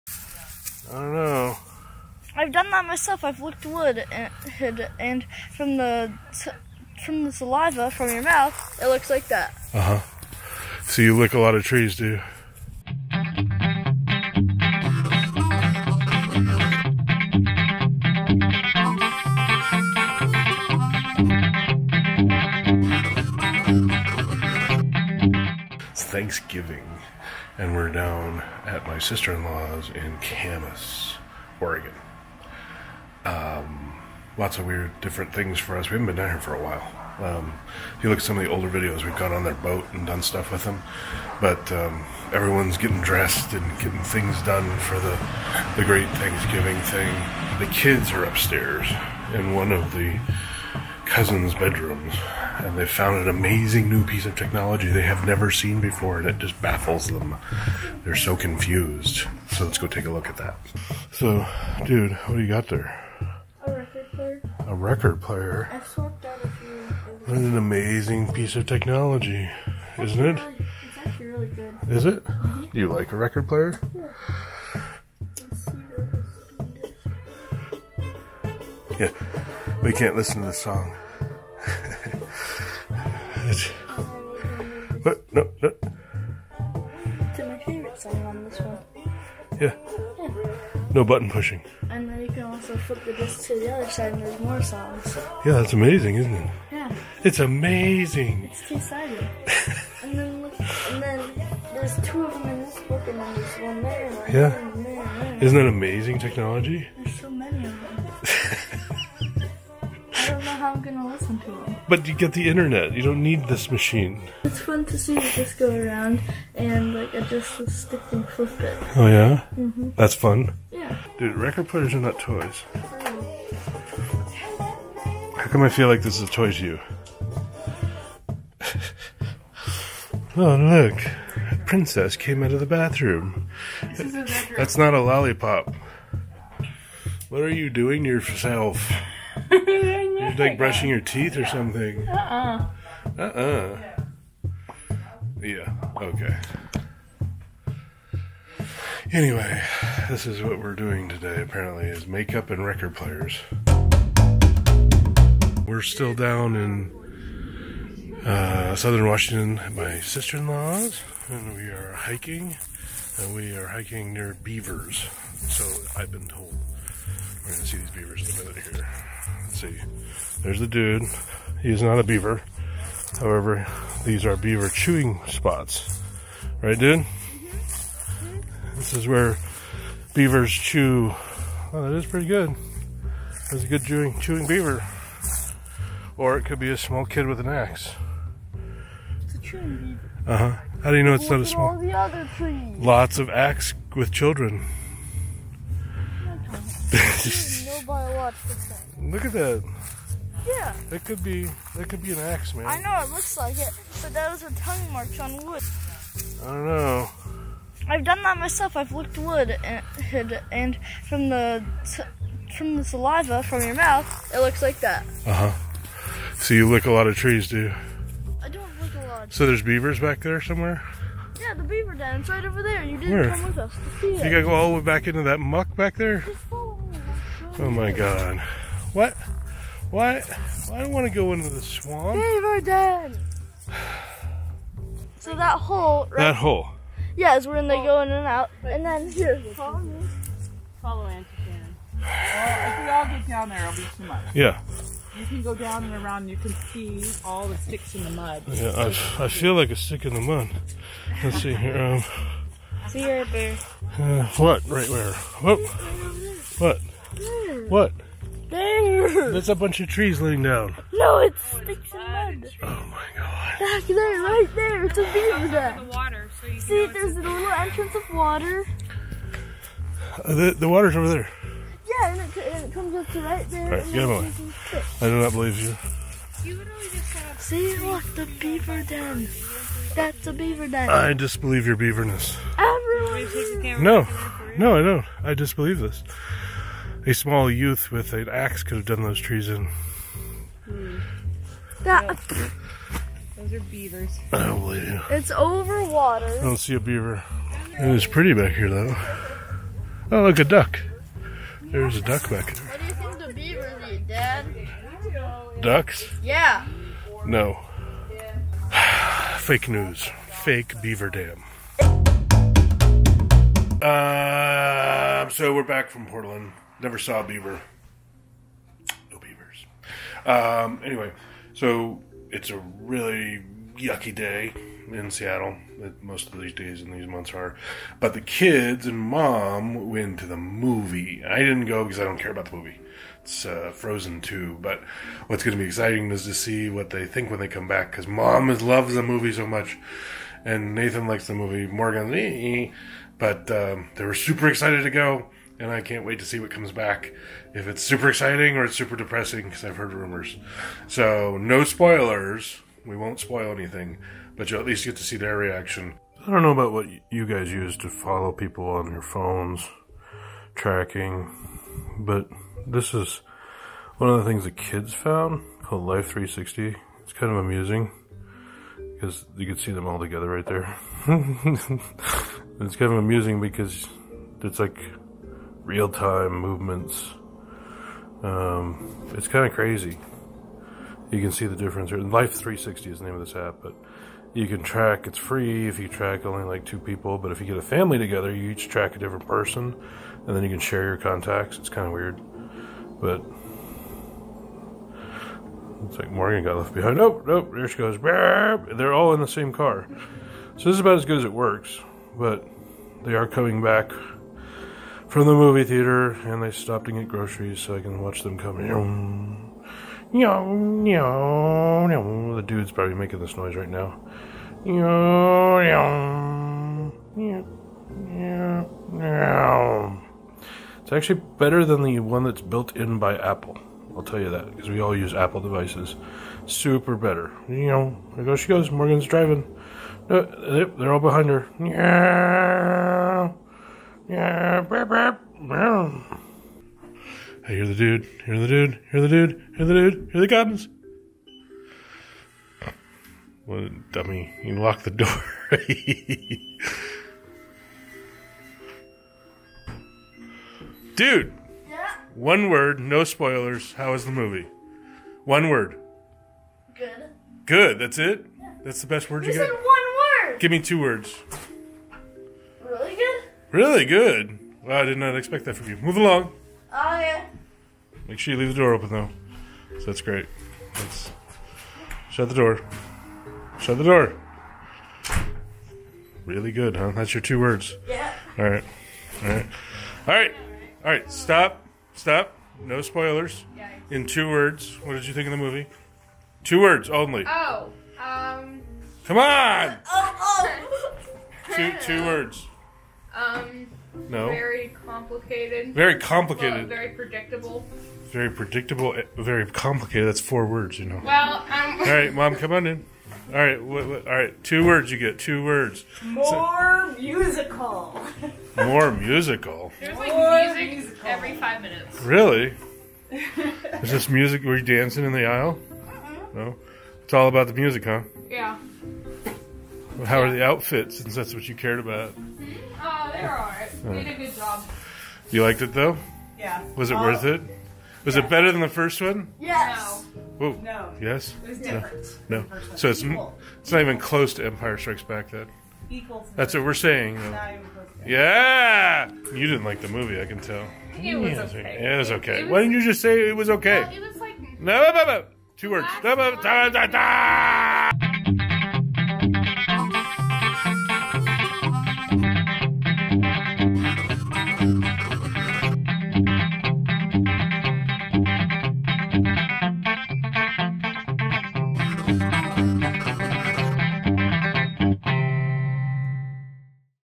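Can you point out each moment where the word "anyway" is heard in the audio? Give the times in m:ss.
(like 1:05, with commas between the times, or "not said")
2:29, 5:20.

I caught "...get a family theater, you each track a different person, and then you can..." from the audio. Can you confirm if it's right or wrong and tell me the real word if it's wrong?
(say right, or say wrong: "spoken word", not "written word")
wrong: "together", not "theater".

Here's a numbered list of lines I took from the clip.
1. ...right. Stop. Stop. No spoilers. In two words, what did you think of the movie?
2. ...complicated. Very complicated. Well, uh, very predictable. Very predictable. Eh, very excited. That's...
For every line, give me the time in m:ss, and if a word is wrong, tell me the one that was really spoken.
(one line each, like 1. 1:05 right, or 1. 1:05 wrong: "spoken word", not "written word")
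1. 8:00 right
2. 8:14 wrong: "complicated", not "excited".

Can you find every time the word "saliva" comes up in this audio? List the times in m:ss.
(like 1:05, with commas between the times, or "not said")
0:07, 3:32.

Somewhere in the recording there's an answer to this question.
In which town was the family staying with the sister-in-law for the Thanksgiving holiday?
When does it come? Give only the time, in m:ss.
0:30.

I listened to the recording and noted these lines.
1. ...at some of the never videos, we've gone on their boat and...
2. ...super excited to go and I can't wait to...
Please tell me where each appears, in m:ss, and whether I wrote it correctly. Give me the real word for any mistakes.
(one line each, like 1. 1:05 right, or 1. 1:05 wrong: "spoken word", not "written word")
1. 0:38 wrong: "older", not "never"
2. 5:44 right.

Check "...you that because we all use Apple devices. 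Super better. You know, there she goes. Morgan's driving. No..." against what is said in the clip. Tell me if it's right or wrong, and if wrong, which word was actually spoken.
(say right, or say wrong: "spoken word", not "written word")
right.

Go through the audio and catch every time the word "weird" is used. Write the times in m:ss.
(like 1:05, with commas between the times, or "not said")
0:34, 6:31.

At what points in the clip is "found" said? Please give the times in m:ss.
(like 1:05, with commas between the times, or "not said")
0:52, 6:04.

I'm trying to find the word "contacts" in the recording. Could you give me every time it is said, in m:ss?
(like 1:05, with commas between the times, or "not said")
6:30.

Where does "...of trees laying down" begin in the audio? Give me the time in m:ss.
4:19.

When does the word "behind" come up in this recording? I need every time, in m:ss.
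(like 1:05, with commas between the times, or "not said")
6:36, 7:11.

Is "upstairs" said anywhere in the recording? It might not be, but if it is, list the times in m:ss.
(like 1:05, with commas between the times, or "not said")
0:48.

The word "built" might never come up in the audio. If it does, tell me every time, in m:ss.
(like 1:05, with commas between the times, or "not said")
7:02.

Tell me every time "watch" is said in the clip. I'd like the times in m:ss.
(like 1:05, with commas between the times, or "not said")
6:48.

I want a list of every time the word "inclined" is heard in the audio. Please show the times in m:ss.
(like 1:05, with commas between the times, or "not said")
not said.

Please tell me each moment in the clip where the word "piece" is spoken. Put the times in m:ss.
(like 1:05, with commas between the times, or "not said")
0:54, 1:08.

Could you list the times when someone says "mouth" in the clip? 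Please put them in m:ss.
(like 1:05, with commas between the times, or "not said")
0:08, 3:33.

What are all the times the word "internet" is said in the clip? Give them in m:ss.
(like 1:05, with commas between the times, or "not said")
1:52.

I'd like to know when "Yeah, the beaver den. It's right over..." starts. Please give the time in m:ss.
3:41.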